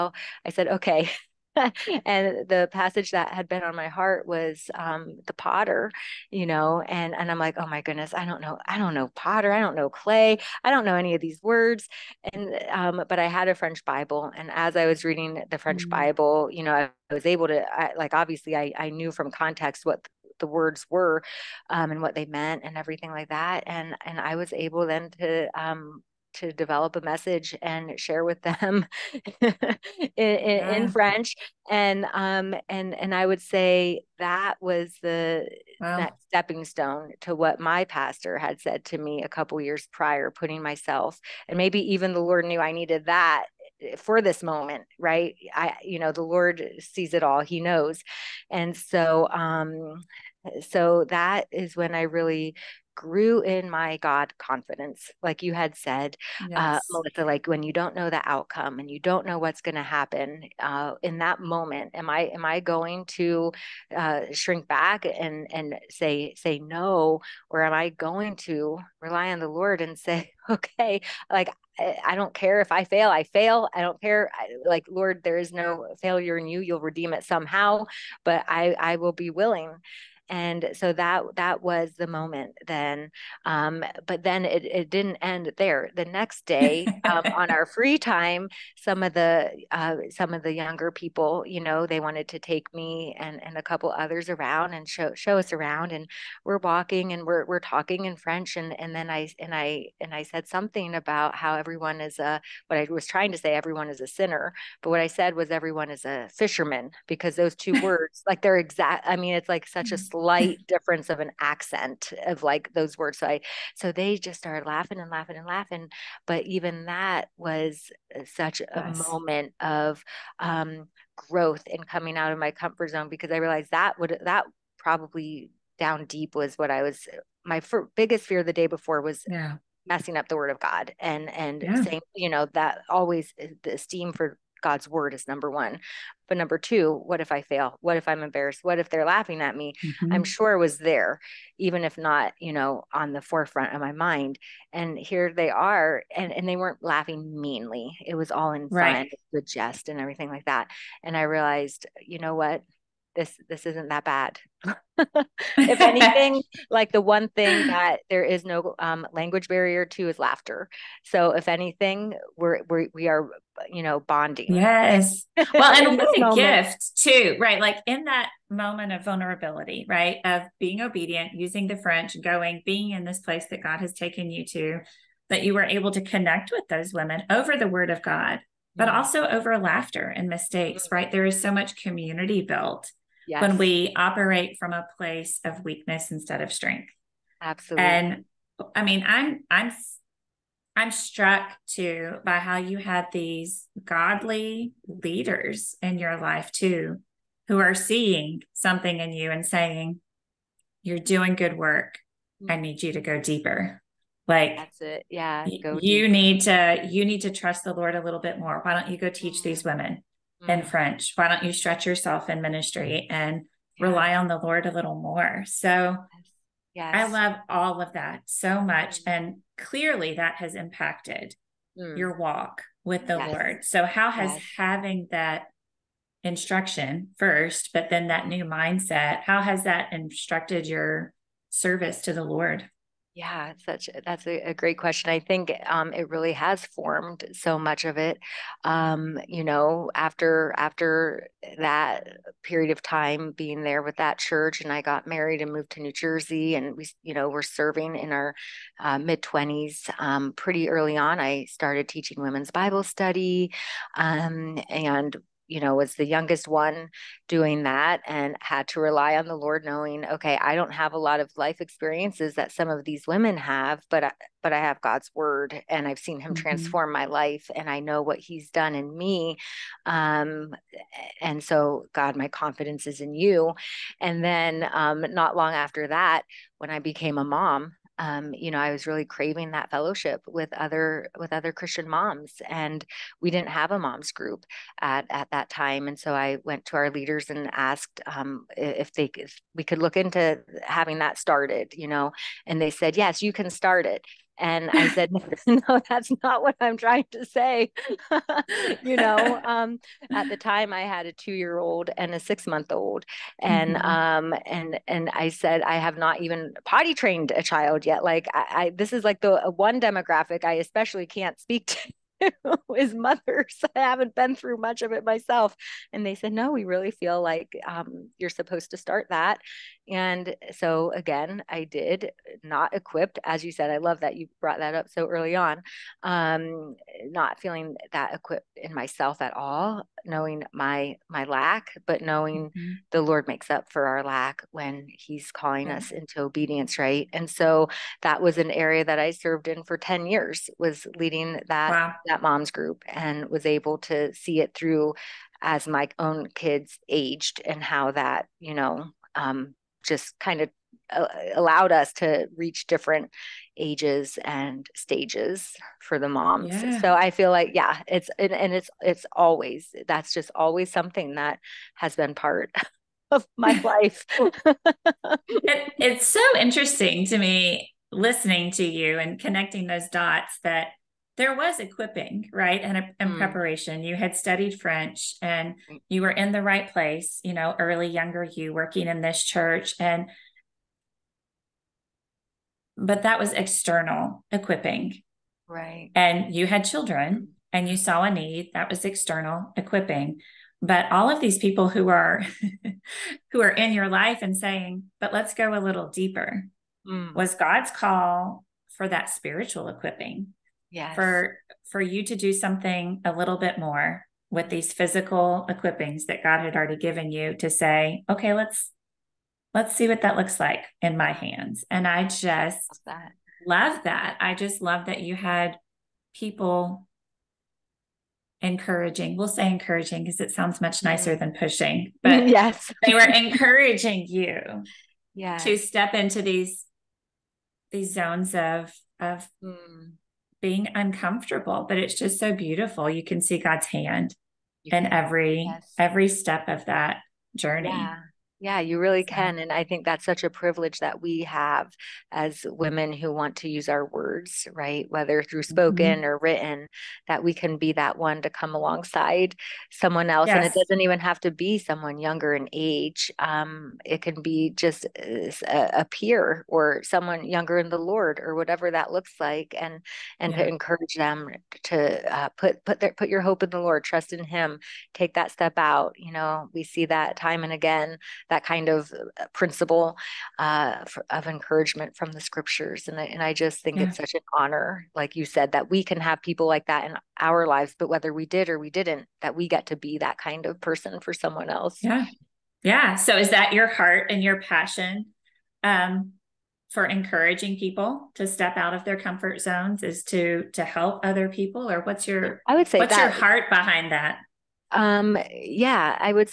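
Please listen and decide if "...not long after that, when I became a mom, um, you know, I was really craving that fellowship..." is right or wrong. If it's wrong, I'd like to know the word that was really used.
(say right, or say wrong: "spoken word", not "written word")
right.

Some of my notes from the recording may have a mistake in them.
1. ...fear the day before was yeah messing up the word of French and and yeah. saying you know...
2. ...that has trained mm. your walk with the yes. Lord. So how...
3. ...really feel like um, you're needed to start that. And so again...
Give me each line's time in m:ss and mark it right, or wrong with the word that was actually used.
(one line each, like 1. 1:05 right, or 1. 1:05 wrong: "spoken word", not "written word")
1. 2:08 wrong: "God", not "French"
2. 3:40 wrong: "impacted", not "trained"
3. 5:16 wrong: "supposed", not "needed".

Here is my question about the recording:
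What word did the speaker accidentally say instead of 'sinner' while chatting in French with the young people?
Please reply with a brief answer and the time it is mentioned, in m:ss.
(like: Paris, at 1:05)
Fisherman, at 1:46.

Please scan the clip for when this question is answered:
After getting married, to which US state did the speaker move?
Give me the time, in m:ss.
4:05.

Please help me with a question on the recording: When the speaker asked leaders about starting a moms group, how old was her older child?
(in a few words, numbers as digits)
2.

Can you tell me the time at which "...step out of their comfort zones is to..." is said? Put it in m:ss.
8:08.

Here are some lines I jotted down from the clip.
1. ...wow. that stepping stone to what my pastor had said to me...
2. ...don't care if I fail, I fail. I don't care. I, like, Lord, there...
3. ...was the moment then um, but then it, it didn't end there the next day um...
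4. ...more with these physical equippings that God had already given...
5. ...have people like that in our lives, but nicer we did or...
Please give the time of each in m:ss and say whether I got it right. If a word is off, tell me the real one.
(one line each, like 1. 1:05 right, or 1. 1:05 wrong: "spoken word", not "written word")
1. 0:35 right
2. 1:12 right
3. 1:21 right
4. 6:43 right
5. 7:55 wrong: "whether", not "nicer".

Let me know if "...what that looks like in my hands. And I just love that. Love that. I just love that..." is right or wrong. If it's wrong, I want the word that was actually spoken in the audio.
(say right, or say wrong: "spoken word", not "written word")
right.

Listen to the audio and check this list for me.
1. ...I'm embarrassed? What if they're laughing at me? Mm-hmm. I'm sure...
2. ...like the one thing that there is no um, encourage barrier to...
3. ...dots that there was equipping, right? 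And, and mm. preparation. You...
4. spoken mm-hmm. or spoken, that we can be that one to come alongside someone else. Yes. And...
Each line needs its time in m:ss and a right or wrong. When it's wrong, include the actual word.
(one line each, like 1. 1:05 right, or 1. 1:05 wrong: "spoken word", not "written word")
1. 2:18 right
2. 2:36 wrong: "language", not "encourage"
3. 6:09 right
4. 7:25 wrong: "written", not "spoken".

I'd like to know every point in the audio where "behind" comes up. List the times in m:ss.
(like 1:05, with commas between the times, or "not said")
8:13.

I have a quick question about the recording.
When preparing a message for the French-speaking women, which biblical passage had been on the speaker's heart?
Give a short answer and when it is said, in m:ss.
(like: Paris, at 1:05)
The potter, at 0:05.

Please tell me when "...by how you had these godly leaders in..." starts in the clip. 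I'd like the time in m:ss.
3:12.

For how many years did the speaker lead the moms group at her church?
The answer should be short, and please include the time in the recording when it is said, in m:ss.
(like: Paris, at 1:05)
10, at 5:39.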